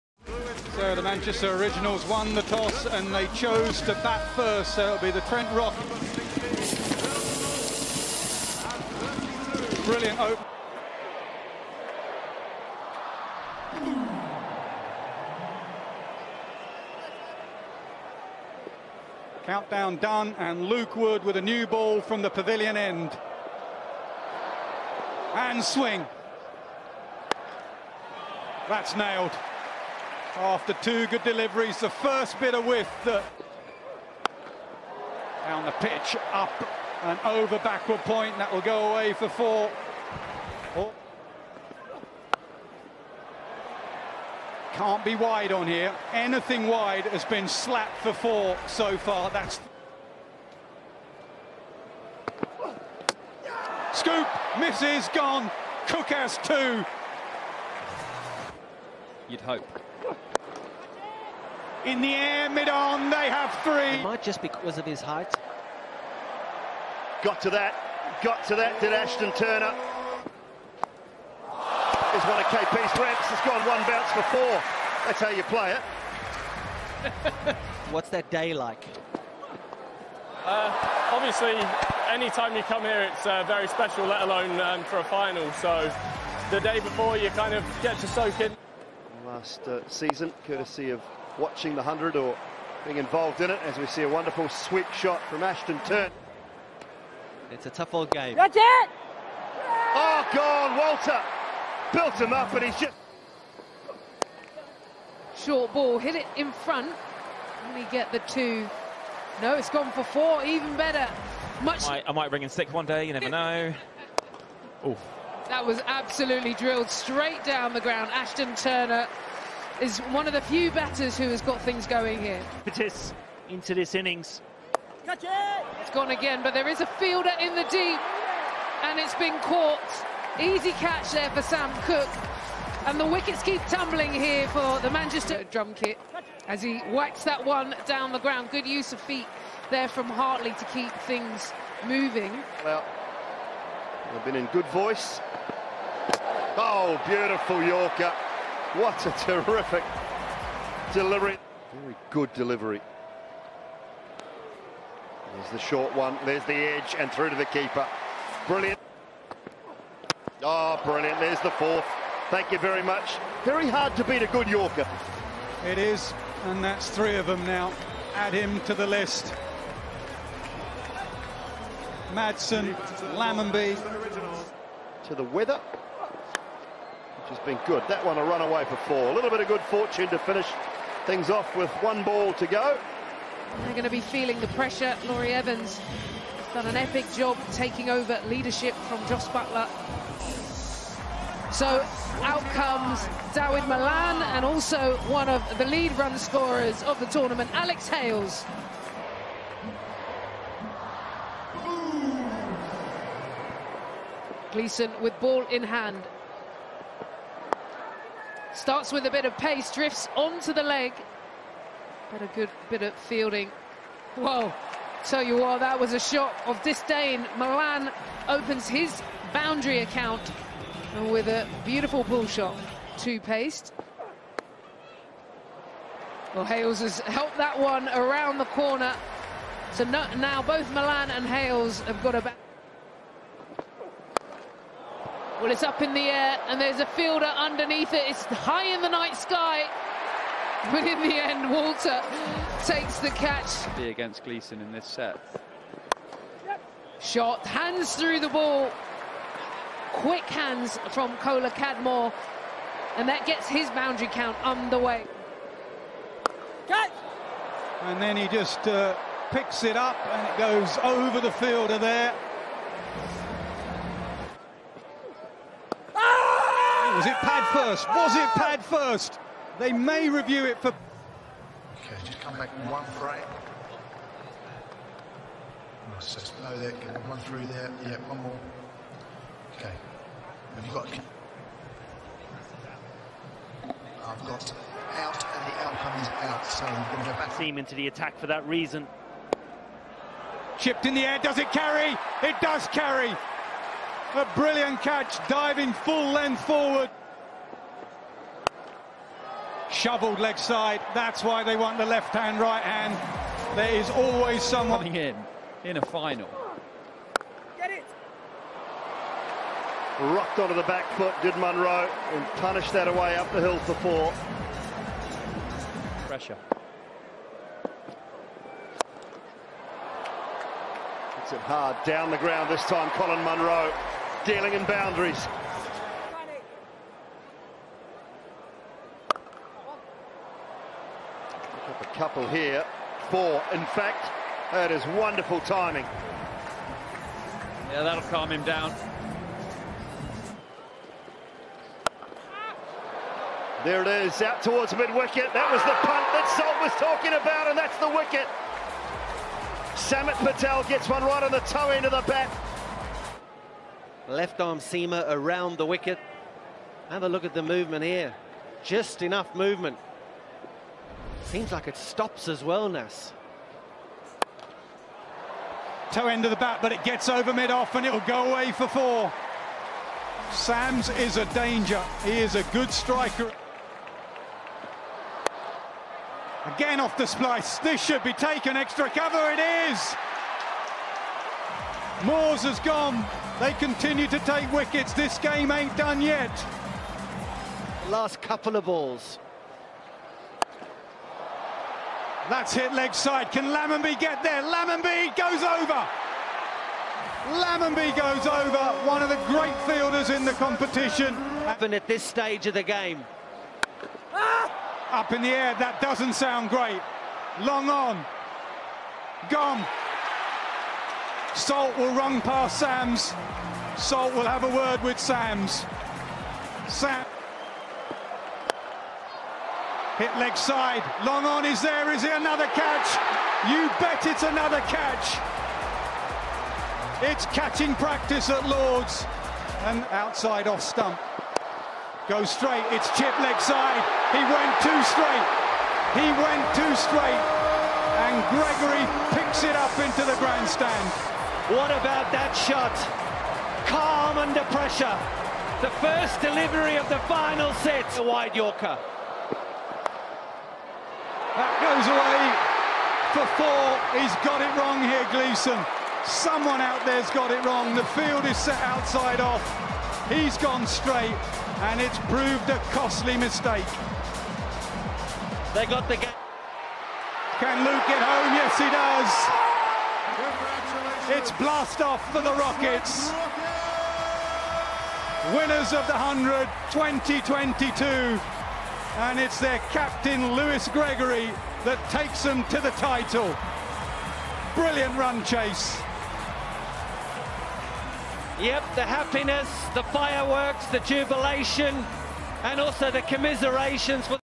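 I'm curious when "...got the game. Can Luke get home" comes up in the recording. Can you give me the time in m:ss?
7:45.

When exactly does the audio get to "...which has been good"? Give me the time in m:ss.
2:57.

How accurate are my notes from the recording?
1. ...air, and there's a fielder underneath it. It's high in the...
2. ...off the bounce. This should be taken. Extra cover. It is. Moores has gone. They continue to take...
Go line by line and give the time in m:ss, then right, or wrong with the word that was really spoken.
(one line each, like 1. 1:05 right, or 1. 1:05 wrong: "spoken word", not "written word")
1. 3:56 right
2. 6:16 wrong: "splice", not "bounce".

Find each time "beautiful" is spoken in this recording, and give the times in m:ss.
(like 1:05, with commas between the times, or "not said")
2:27, 3:41.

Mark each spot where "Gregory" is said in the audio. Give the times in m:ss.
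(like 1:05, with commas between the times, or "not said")
7:18, 8:00.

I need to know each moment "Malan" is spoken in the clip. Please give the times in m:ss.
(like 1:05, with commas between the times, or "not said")
3:13, 3:37, 3:50.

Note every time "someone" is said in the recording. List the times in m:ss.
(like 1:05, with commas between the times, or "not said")
5:04, 7:36.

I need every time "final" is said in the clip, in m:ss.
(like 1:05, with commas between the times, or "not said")
1:25, 5:05, 7:27.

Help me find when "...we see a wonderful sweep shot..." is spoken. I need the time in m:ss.
1:33.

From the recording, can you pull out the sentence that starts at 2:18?
Good use of feet there from Hartley to keep things moving.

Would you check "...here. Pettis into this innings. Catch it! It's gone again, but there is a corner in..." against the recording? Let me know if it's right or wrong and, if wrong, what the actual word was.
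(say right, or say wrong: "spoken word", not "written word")
wrong: "fielder", not "corner".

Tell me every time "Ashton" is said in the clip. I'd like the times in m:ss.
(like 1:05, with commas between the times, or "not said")
1:08, 1:35, 1:58.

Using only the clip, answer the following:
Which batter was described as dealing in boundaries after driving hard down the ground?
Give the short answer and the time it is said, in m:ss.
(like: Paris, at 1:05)
Colin Munro, at 5:22.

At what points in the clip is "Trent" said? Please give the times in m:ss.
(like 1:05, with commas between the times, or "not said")
0:05.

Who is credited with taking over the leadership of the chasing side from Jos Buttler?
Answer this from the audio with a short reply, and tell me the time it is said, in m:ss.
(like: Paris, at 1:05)
Laurie Evans, at 3:05.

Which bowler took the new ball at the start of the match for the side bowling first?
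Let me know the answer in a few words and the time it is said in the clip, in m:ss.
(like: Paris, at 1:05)
Luke Wood, at 0:20.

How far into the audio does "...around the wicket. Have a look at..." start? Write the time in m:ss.
5:55.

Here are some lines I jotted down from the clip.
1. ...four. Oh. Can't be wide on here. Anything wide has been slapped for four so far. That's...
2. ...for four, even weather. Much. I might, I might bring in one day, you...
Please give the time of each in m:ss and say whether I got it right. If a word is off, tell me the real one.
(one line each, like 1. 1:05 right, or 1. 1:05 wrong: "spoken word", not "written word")
1. 0:39 right
2. 1:49 wrong: "better", not "weather".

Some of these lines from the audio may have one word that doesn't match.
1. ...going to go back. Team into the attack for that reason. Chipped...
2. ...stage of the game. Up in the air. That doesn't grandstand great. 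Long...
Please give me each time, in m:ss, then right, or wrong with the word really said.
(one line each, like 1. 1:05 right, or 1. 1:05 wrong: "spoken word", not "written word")
1. 4:46 right
2. 6:42 wrong: "sound", not "grandstand".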